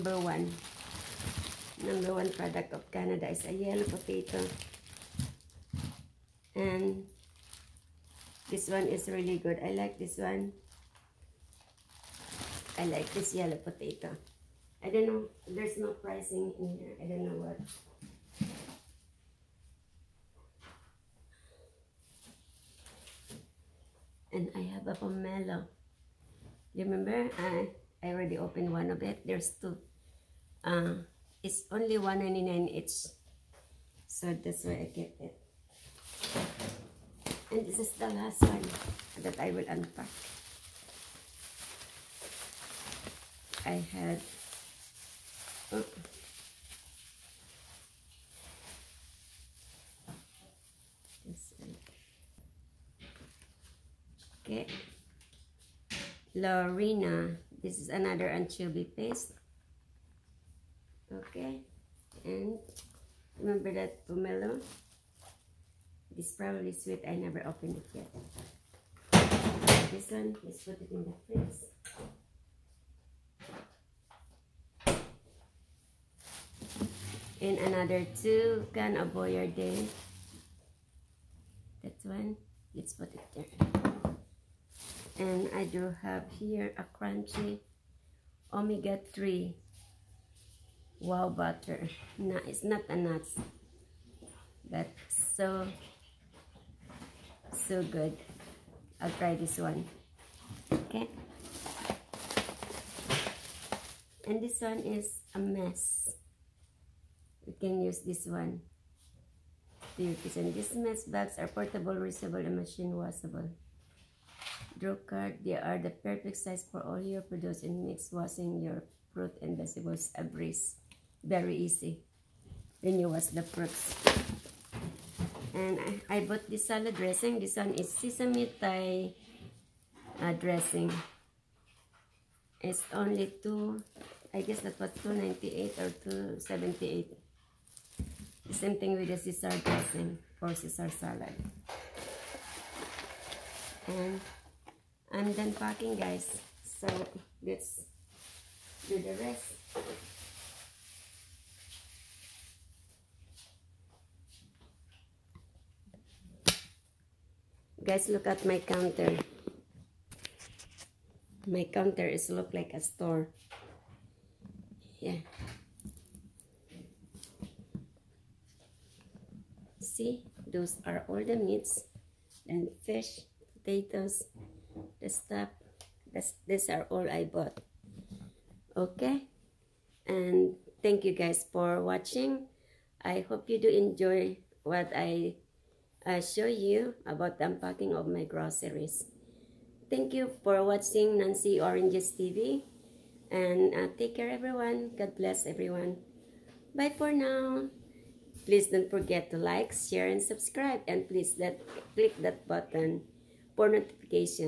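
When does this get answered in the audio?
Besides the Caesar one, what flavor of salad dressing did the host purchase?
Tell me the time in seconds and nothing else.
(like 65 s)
127 s.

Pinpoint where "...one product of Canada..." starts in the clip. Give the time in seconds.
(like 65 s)
2 s.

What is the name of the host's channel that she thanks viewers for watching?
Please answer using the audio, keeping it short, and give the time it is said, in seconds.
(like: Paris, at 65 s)
Nancy Oranges TV, at 191 s.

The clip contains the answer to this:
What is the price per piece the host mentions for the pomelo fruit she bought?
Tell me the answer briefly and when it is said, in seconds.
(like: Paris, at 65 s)
$1.99, at 32 s.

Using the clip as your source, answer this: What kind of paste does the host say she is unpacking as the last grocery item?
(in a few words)
Anchovy paste.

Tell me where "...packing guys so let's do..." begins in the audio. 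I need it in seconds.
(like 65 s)
145 s.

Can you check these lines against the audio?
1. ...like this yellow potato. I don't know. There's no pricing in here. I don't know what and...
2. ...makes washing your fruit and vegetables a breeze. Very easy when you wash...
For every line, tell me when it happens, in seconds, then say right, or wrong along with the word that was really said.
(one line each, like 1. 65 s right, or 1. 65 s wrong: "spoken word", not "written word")
1. 12 s right
2. 117 s right.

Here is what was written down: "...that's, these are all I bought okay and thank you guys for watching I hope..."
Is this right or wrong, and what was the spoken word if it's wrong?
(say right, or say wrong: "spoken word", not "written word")
right.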